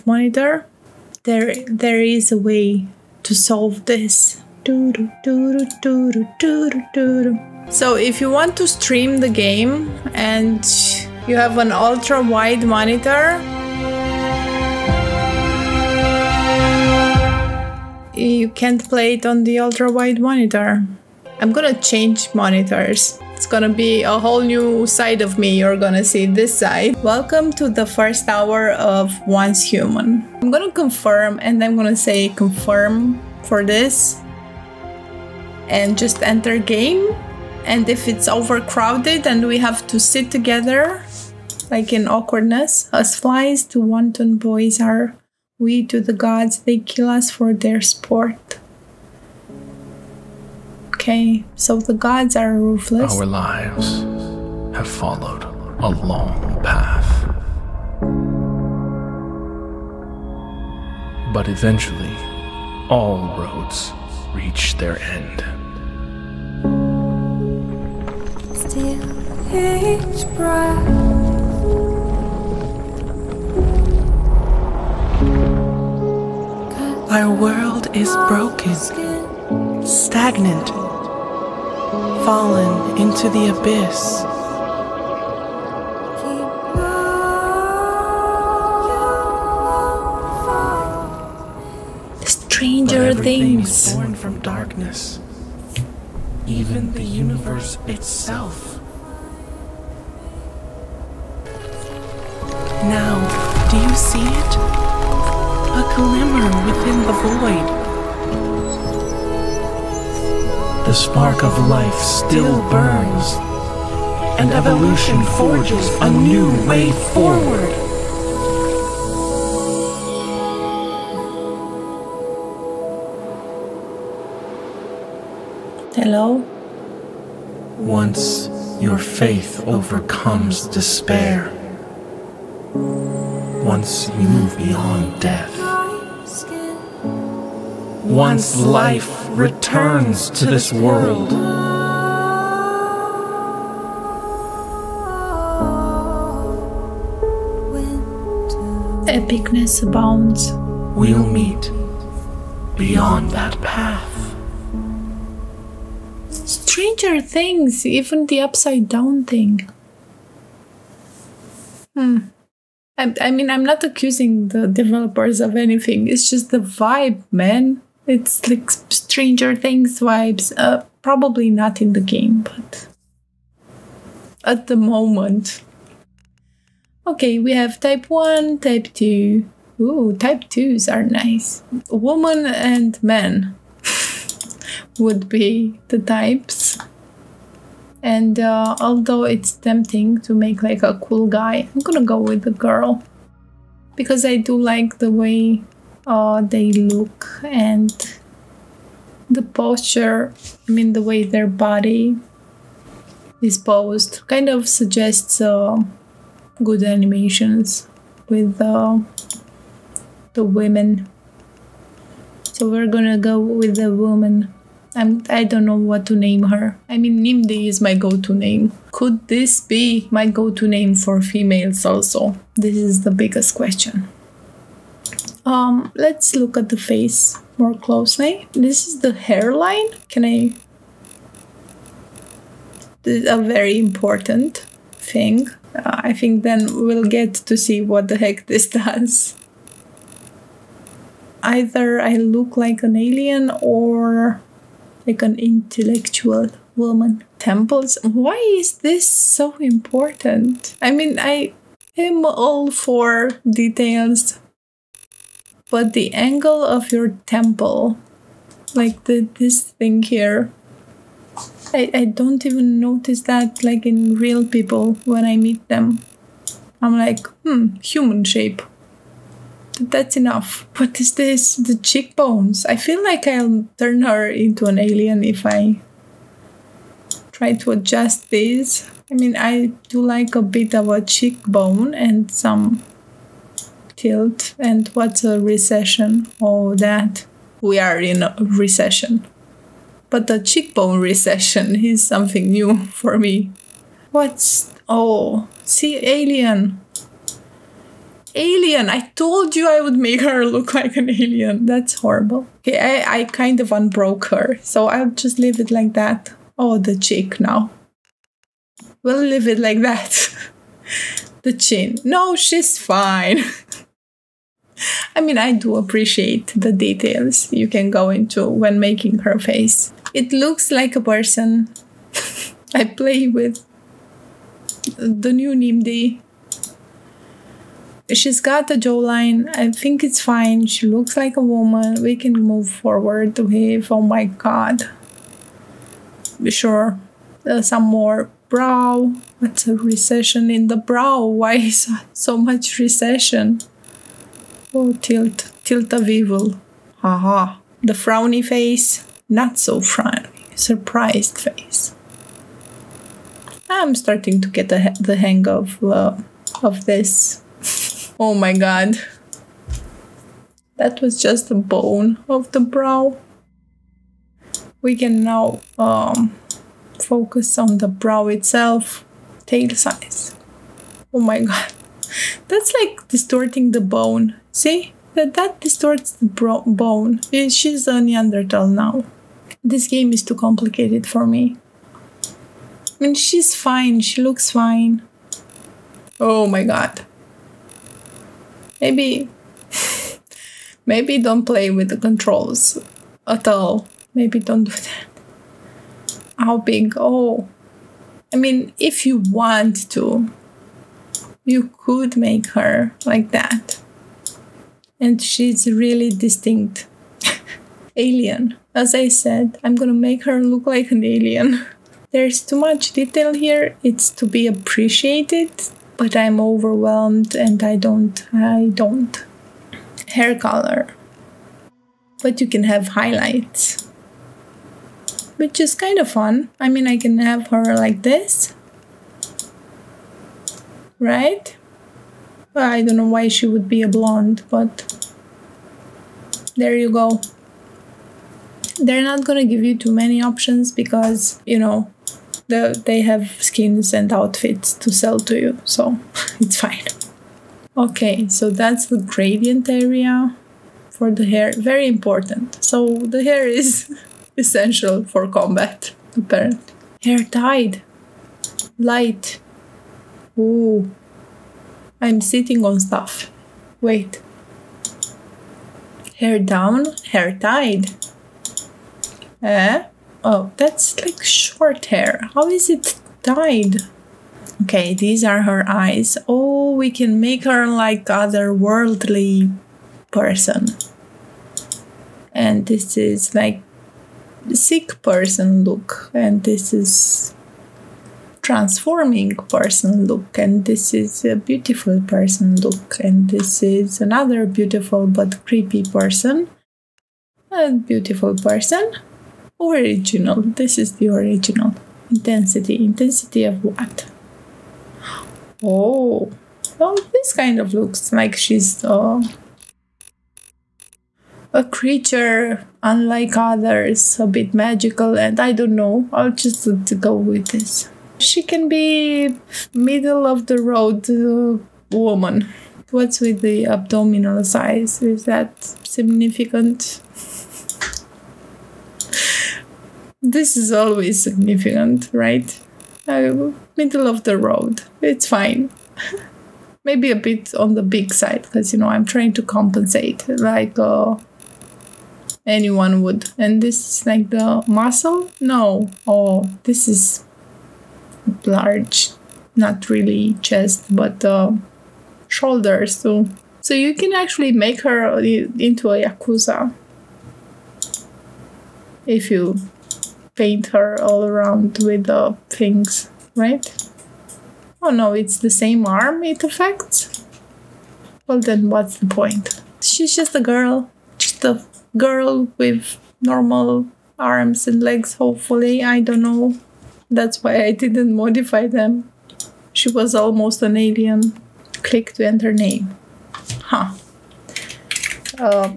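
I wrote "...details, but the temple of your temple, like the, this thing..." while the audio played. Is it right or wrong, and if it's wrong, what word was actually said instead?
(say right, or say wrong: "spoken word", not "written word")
wrong: "angle", not "temple".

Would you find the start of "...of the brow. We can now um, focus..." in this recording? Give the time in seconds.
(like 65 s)
362 s.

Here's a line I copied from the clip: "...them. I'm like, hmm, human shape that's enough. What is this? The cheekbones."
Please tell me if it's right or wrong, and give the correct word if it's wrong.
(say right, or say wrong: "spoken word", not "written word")
right.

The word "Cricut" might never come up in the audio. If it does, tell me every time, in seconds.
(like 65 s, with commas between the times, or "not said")
not said.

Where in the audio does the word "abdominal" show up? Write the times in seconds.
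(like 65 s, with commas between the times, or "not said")
523 s.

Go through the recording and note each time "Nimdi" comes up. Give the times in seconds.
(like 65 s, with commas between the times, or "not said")
217 s, 325 s.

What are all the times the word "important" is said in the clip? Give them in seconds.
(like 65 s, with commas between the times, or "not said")
233 s, 249 s, 451 s.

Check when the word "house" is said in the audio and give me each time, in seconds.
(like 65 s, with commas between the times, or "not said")
not said.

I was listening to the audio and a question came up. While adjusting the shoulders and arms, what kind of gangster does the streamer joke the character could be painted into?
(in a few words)
Yakuza.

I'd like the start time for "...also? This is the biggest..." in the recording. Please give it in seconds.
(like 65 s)
221 s.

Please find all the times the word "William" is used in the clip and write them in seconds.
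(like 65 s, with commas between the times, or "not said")
not said.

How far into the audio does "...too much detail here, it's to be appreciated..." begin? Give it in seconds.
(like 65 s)
412 s.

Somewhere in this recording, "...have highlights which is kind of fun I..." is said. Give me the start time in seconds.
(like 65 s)
422 s.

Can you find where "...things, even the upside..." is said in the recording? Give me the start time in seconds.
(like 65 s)
157 s.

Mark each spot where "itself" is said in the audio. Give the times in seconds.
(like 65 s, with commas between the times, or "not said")
97 s, 368 s.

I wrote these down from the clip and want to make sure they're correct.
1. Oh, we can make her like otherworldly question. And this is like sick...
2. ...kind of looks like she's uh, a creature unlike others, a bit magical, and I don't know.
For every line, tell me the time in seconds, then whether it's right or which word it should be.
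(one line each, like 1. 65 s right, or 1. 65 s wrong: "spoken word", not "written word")
1. 476 s wrong: "person", not "question"
2. 507 s right.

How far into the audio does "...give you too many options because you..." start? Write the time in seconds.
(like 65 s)
439 s.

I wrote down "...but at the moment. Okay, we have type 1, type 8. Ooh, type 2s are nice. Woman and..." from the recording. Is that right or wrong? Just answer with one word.
wrong.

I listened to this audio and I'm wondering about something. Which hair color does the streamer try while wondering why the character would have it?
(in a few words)
Blonde.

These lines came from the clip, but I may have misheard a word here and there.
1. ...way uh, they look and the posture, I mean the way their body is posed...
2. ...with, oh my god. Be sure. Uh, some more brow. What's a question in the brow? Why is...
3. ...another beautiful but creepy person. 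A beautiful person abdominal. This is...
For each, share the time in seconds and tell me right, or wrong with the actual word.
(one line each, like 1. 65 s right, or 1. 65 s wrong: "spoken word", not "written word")
1. 195 s right
2. 333 s wrong: "recession", not "question"
3. 494 s wrong: "original", not "abdominal".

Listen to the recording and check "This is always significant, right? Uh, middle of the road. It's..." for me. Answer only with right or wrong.
right.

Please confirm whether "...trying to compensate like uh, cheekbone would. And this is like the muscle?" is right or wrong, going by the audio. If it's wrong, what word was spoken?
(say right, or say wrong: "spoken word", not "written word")
wrong: "anyone", not "cheekbone".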